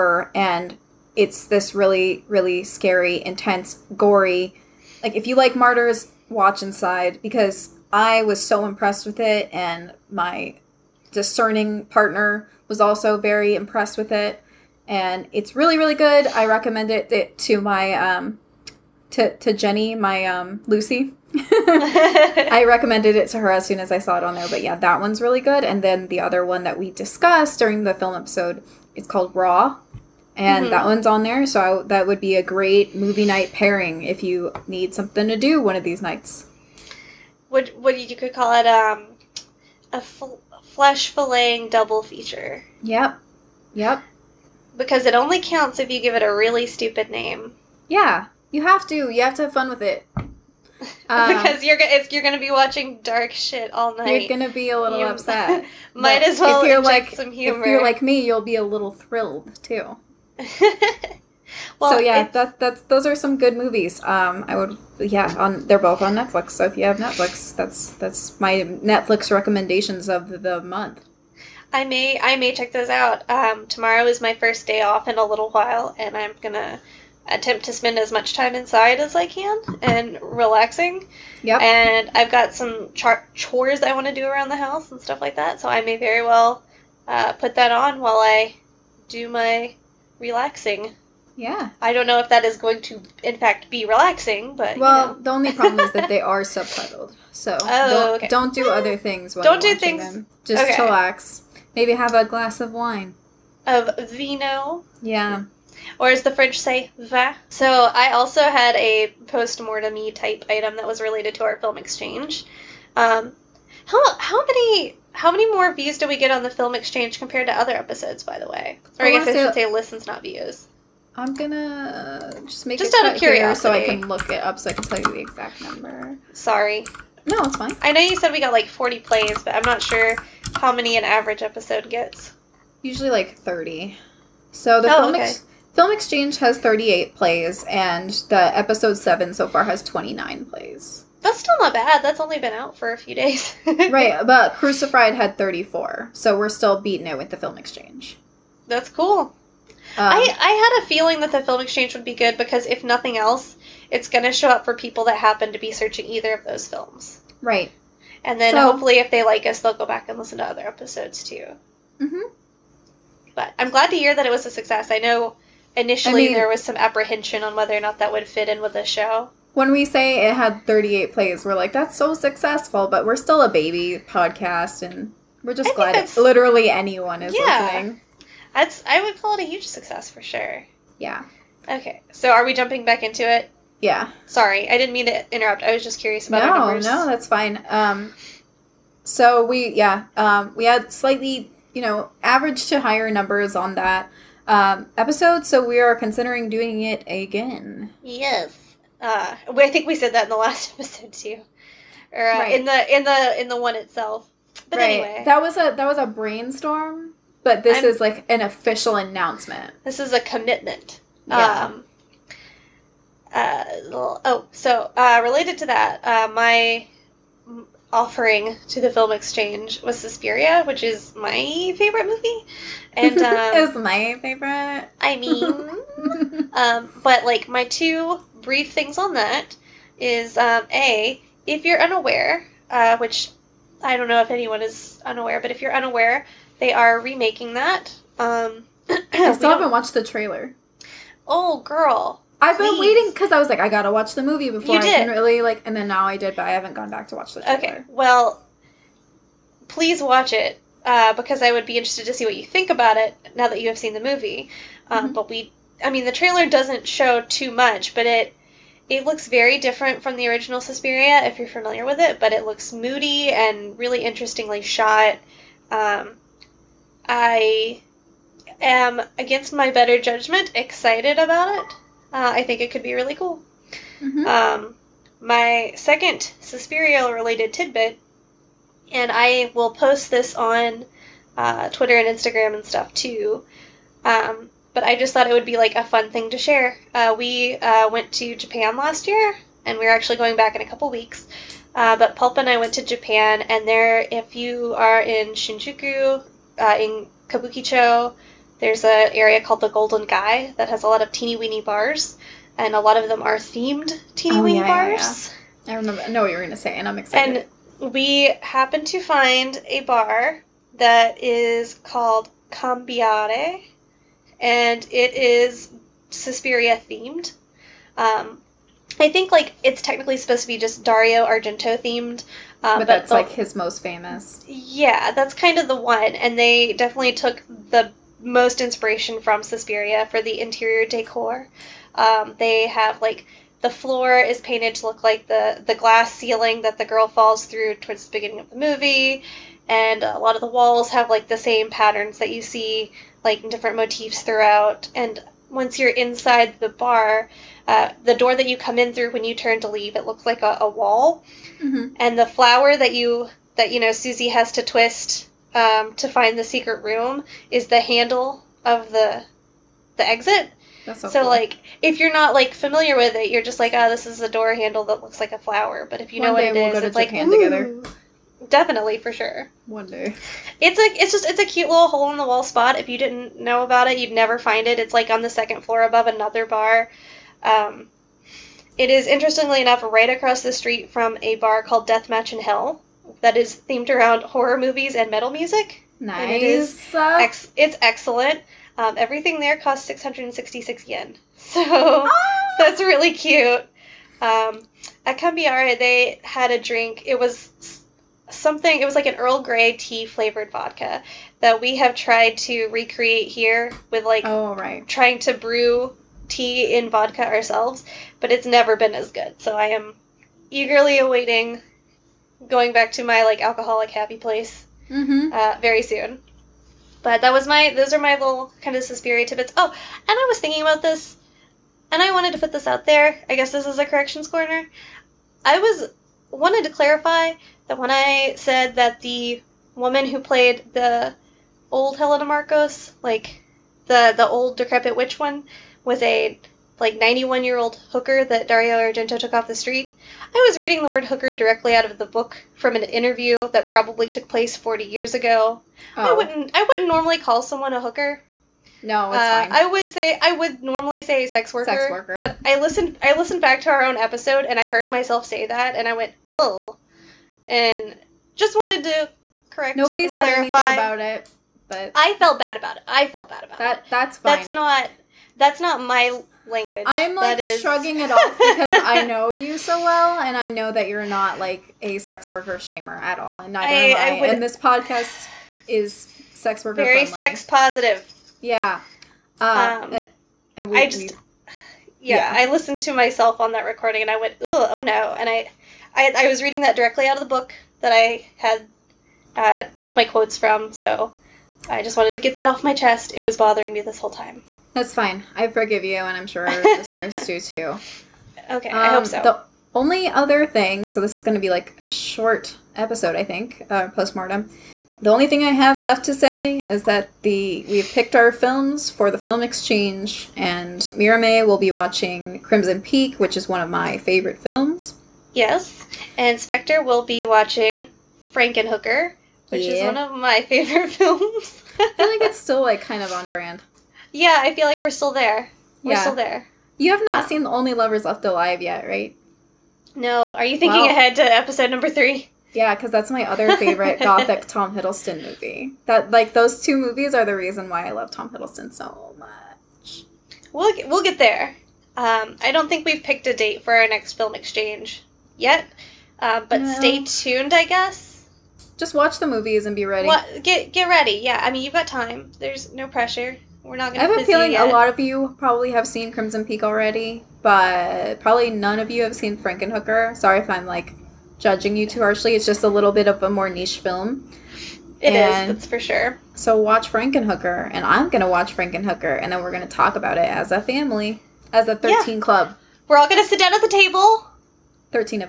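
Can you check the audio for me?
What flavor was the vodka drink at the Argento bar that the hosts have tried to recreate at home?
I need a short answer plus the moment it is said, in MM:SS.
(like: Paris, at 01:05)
Earl Grey tea, at 06:39.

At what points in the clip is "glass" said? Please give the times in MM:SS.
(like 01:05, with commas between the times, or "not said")
01:42, 05:35.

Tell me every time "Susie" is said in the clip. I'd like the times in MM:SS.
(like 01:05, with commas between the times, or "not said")
05:53.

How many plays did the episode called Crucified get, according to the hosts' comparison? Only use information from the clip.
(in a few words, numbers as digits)
34.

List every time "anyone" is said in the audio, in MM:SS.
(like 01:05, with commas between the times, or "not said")
02:56, 03:54.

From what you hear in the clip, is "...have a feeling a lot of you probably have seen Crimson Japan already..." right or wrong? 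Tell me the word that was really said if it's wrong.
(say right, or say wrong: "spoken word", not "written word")
wrong: "Peak", not "Japan".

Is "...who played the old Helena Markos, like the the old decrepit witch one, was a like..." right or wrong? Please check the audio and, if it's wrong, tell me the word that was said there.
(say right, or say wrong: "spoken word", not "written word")
right.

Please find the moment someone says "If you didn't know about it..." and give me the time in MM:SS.
06:12.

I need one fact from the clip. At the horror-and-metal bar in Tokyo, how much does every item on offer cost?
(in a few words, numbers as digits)
666 yen.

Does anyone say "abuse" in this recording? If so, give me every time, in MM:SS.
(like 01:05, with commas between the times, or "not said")
not said.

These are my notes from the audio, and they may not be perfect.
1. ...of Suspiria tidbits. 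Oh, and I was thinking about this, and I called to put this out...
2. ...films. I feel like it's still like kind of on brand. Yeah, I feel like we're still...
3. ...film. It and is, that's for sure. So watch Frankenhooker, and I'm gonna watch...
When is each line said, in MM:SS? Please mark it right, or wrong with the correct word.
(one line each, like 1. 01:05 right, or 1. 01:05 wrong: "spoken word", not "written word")
1. 06:58 wrong: "wanted", not "called"
2. 08:40 right
3. 09:23 right.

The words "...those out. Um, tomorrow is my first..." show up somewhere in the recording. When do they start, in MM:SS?
01:12.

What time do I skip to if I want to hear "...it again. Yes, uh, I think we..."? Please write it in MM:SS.
03:16.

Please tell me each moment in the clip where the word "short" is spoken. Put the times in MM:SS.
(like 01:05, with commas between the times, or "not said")
08:21.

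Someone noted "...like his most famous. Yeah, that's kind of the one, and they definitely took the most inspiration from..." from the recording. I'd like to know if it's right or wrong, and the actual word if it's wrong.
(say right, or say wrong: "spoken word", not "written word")
right.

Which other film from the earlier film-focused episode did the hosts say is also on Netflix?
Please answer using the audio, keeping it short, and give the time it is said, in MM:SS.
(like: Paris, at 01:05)
Raw, at 00:29.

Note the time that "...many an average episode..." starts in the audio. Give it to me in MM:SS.
02:10.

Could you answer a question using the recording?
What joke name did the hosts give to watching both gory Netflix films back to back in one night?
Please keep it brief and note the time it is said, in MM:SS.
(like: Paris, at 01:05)
flesh filleting double feature, at 00:40.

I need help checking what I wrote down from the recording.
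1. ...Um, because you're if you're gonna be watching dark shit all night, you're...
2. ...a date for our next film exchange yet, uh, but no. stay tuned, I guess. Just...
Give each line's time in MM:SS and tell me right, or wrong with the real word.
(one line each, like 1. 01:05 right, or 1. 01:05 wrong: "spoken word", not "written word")
1. 00:51 right
2. 09:03 right.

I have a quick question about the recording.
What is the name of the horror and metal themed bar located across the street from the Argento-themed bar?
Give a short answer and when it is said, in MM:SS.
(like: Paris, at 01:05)
Deathmatch in Hell, at 06:21.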